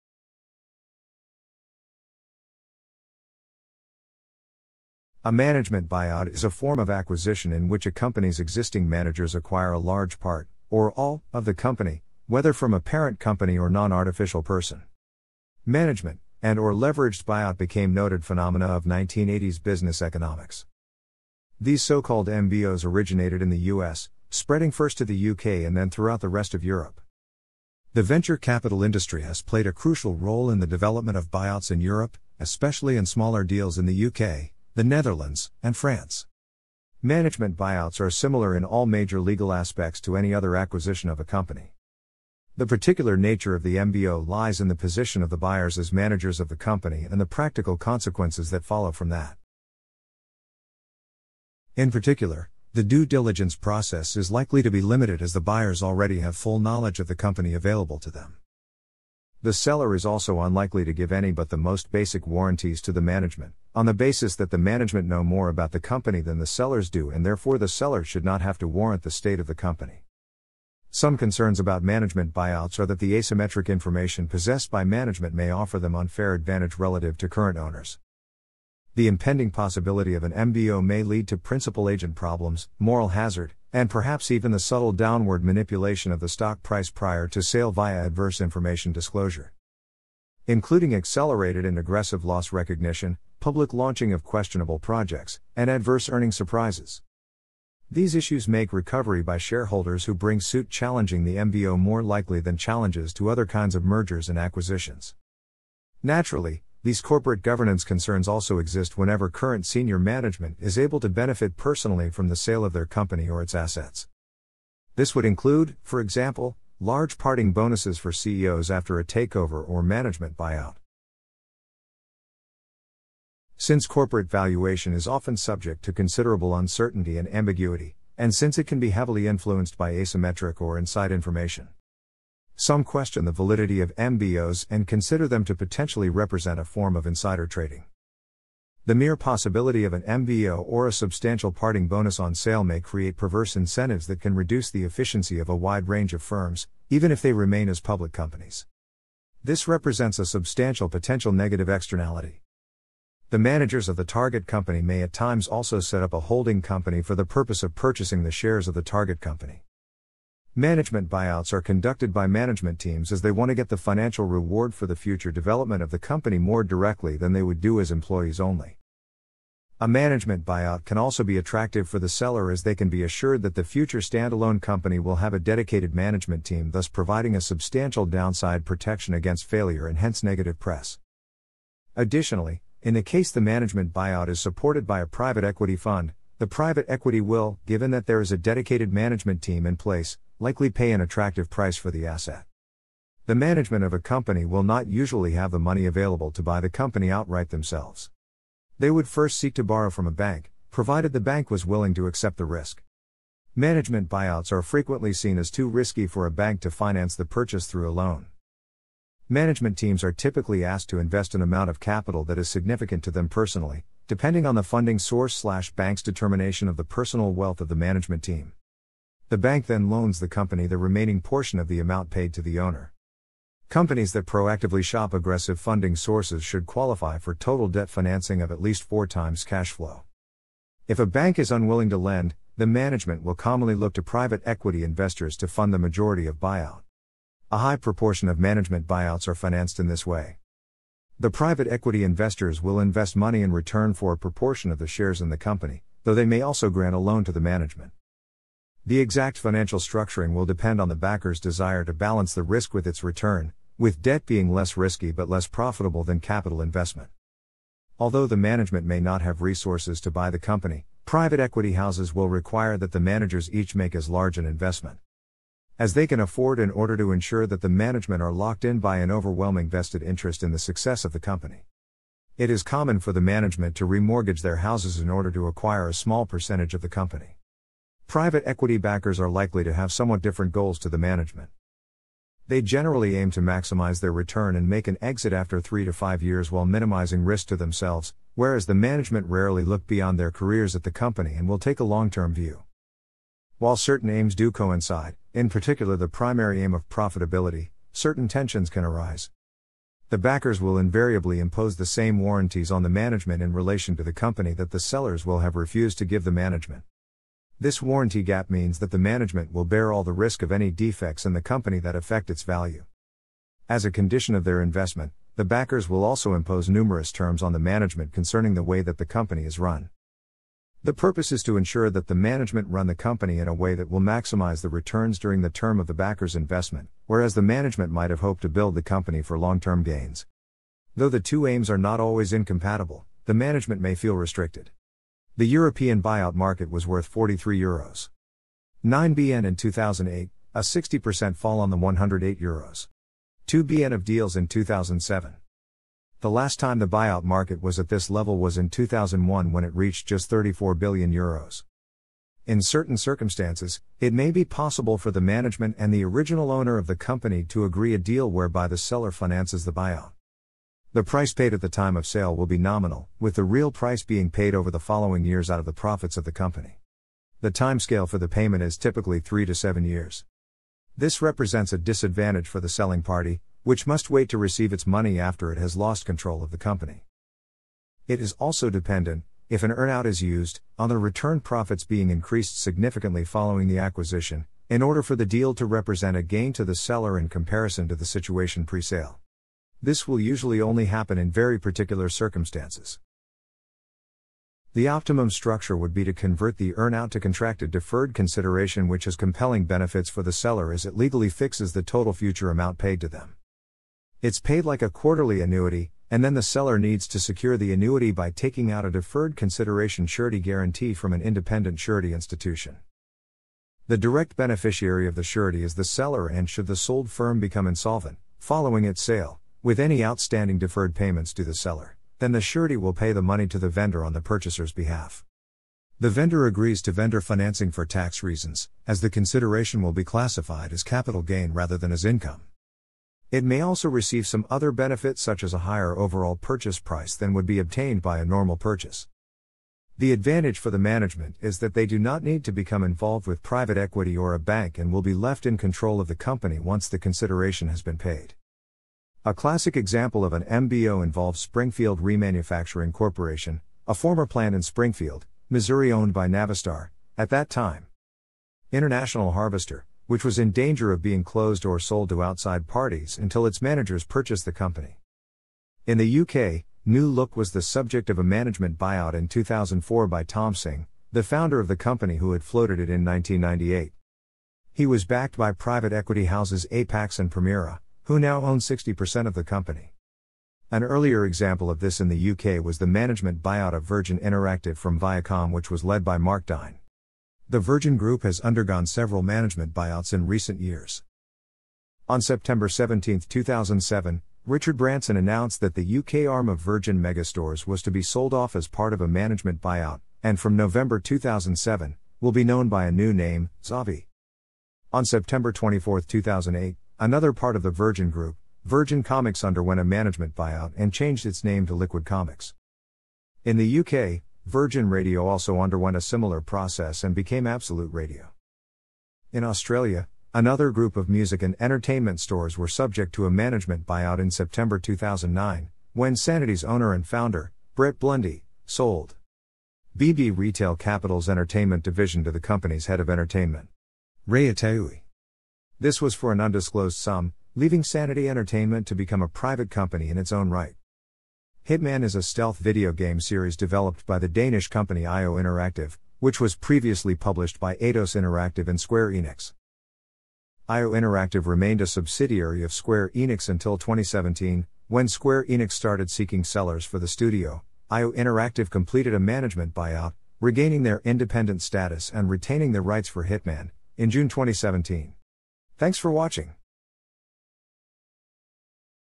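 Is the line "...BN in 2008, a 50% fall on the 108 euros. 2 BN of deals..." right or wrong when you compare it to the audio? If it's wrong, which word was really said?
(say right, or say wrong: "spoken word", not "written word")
wrong: "60", not "50".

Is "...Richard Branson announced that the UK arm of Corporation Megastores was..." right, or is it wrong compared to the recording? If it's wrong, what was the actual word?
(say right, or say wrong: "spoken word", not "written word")
wrong: "Virgin", not "Corporation".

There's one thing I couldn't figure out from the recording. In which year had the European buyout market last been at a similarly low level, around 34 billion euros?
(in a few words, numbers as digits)
2001.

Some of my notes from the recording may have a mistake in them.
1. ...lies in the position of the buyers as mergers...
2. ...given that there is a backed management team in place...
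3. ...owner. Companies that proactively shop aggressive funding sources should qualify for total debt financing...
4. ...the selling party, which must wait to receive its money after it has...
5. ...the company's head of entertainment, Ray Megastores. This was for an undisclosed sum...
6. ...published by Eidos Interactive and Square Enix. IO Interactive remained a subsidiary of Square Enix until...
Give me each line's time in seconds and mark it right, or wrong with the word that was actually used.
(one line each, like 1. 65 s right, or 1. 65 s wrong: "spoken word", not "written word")
1. 44 s wrong: "managers", not "mergers"
2. 187 s wrong: "dedicated", not "backed"
3. 222 s right
4. 372 s right
5. 532 s wrong: "Itaoui", not "Megastores"
6. 547 s right.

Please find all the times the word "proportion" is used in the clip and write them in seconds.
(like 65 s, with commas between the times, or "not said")
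237 s, 244 s.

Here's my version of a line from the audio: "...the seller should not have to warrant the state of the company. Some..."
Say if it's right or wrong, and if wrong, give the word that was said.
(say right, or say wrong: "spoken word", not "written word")
right.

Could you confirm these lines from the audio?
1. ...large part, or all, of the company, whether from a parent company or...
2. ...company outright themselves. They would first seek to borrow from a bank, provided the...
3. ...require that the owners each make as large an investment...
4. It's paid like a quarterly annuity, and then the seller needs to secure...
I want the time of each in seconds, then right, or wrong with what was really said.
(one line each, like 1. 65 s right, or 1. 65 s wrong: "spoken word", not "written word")
1. 9 s right
2. 196 s right
3. 262 s wrong: "managers", not "owners"
4. 404 s right.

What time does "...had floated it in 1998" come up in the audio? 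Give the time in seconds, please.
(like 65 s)
472 s.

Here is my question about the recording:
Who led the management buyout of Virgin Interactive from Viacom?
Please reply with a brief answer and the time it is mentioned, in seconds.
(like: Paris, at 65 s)
Mark Dyne, at 486 s.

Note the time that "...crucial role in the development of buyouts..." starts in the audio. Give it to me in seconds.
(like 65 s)
29 s.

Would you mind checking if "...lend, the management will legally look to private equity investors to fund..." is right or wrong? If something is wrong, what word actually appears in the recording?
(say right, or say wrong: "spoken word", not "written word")
wrong: "commonly", not "legally".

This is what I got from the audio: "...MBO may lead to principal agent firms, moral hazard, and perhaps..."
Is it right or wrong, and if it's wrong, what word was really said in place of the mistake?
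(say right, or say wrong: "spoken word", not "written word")
wrong: "problems", not "firms".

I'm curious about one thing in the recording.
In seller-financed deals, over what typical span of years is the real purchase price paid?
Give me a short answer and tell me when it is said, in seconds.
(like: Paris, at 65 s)
3 to 7 years, at 369 s.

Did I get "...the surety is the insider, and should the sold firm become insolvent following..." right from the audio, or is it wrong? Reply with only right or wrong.
wrong.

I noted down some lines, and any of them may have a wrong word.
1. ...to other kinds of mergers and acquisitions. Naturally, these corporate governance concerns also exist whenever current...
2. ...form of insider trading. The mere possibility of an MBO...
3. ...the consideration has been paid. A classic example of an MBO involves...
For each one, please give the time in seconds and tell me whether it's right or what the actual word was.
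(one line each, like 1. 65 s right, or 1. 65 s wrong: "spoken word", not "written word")
1. 103 s right
2. 136 s right
3. 446 s right.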